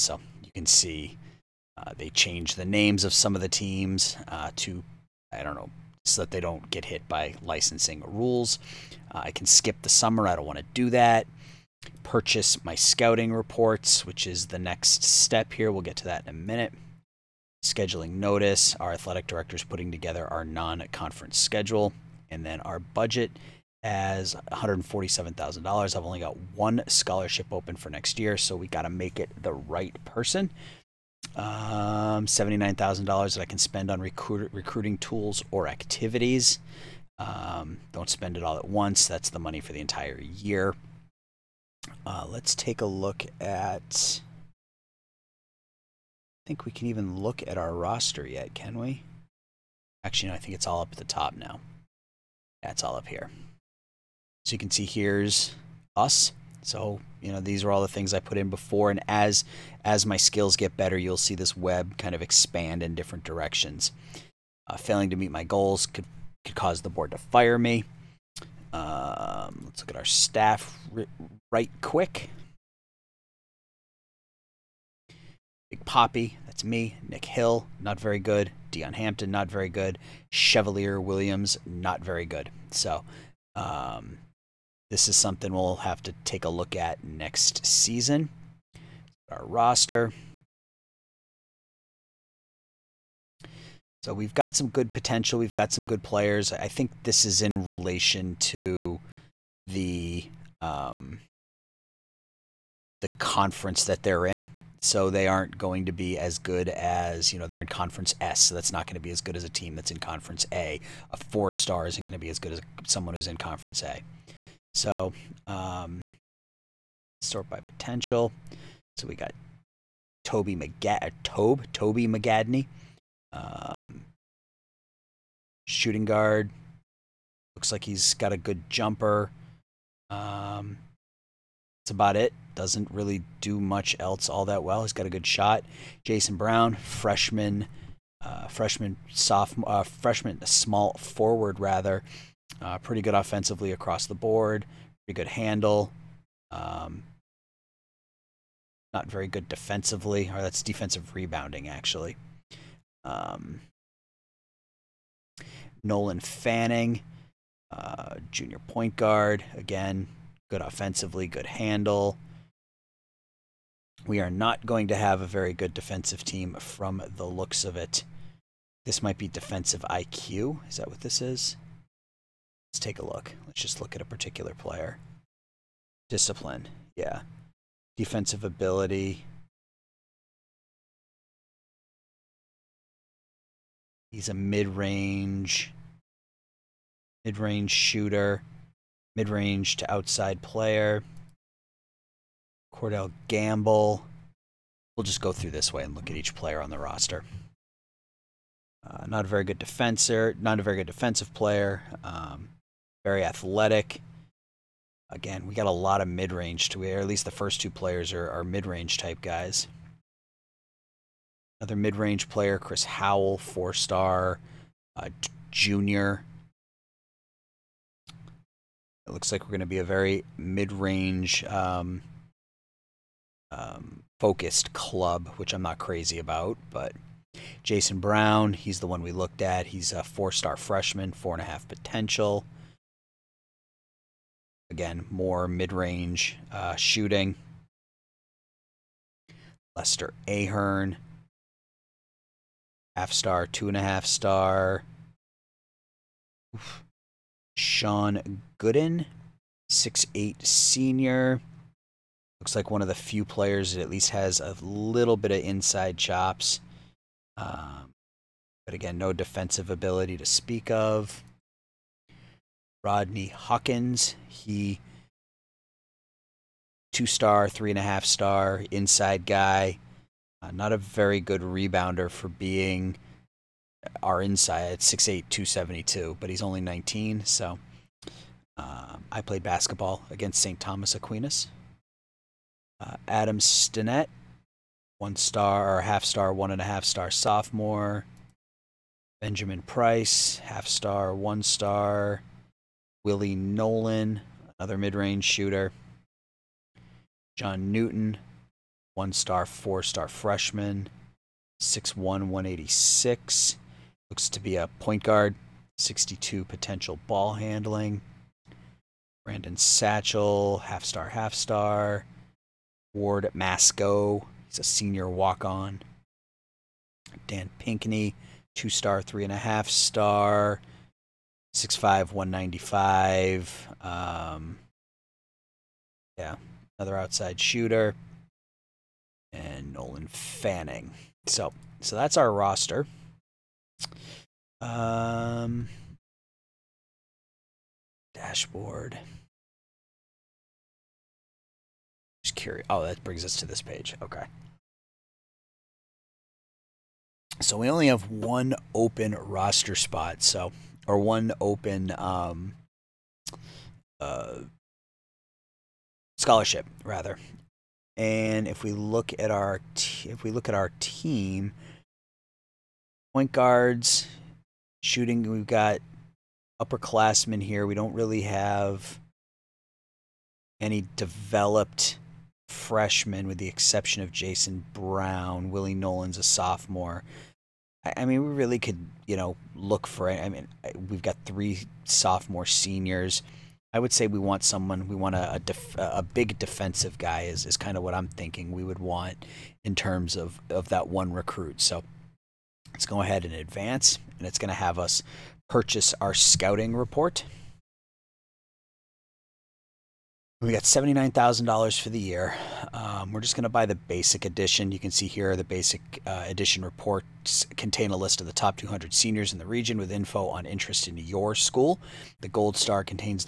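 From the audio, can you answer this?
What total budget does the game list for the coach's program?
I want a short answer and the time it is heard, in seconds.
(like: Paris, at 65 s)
$147,000, at 24 s.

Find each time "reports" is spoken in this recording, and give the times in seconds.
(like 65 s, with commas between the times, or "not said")
13 s, 396 s, 406 s.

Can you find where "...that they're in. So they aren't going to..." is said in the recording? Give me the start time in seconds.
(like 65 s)
103 s.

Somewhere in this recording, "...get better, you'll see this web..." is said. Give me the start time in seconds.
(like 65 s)
60 s.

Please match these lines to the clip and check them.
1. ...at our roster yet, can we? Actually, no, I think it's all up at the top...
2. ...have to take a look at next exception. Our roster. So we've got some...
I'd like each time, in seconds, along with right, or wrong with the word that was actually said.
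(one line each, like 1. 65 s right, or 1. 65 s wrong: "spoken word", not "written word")
1. 47 s right
2. 85 s wrong: "season", not "exception".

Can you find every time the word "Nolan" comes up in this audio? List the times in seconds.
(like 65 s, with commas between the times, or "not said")
155 s, 293 s, 329 s, 375 s.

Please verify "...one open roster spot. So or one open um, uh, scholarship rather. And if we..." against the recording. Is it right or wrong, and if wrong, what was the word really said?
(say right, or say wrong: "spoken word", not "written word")
right.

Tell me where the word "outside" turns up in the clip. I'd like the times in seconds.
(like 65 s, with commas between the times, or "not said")
189 s, 326 s.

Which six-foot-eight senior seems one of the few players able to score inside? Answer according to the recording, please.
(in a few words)
Sean Gooden.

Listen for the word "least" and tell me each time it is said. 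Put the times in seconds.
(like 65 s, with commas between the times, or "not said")
207 s, 253 s.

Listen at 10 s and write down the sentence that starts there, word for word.
I don't want to do that.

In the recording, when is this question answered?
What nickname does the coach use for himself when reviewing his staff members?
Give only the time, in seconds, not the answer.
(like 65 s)
75 s.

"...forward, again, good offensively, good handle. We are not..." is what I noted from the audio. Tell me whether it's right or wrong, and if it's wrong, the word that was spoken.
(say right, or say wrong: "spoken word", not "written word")
wrong: "guard", not "forward".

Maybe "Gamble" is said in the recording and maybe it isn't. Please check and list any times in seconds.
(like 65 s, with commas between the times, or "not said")
193 s.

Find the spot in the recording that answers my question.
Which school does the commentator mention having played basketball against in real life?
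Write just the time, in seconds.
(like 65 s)
280 s.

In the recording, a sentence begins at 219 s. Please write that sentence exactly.
It looks like we're going to be a very mid range um, um, focused club, which I'm not crazy about.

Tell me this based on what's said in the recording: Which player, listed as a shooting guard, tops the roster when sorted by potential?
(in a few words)
Toby McGadney.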